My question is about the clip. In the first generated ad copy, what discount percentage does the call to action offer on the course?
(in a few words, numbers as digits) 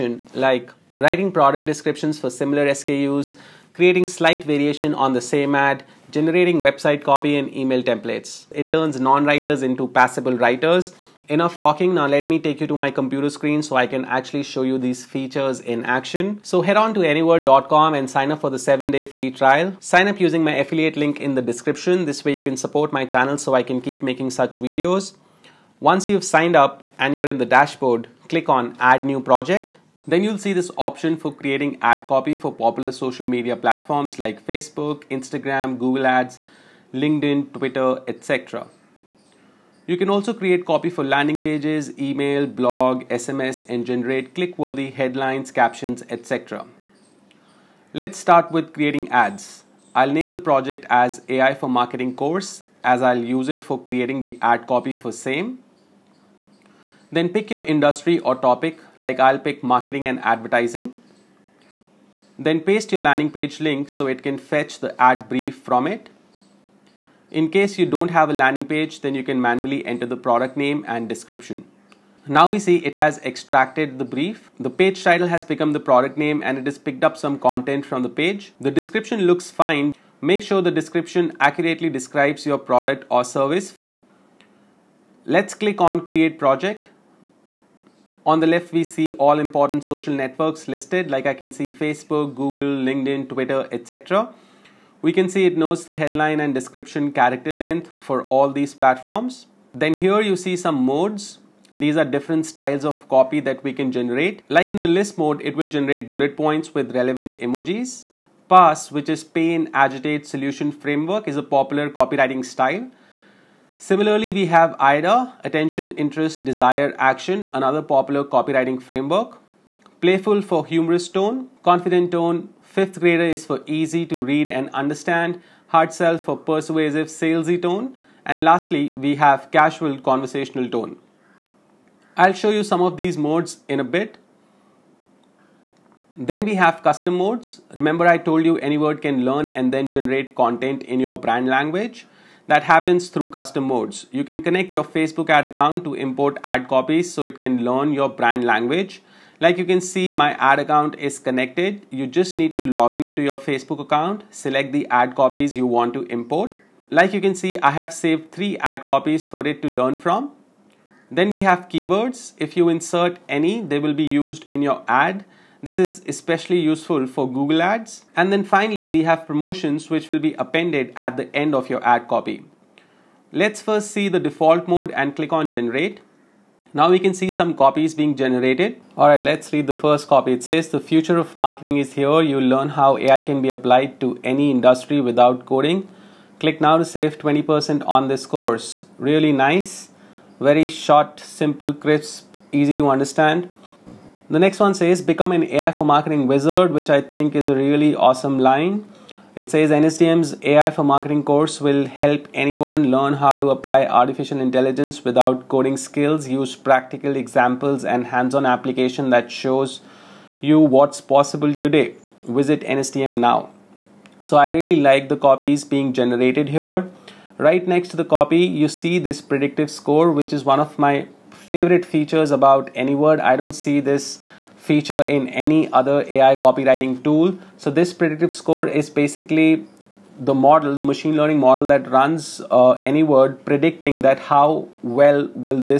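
20%.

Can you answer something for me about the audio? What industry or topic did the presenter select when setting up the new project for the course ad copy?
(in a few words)
marketing and advertising.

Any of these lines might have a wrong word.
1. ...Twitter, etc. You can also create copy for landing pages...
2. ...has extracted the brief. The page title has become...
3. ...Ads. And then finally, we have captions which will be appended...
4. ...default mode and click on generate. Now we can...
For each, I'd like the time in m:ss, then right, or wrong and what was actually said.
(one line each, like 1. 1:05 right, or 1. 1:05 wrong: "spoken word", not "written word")
1. 0:37 right
2. 1:12 right
3. 2:47 wrong: "promotions", not "captions"
4. 2:54 right.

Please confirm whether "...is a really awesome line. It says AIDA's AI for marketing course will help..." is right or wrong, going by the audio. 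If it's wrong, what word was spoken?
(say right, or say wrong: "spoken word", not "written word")
wrong: "NSTM", not "AIDA".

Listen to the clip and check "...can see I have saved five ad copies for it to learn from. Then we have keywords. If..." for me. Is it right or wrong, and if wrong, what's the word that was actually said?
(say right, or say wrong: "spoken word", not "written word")
wrong: "three", not "five".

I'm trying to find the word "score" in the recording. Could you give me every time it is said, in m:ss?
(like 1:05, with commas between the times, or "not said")
3:39, 3:48.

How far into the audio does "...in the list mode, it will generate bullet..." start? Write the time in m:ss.
1:44.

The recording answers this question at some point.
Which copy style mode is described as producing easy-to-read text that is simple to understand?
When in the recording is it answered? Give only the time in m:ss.
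2:02.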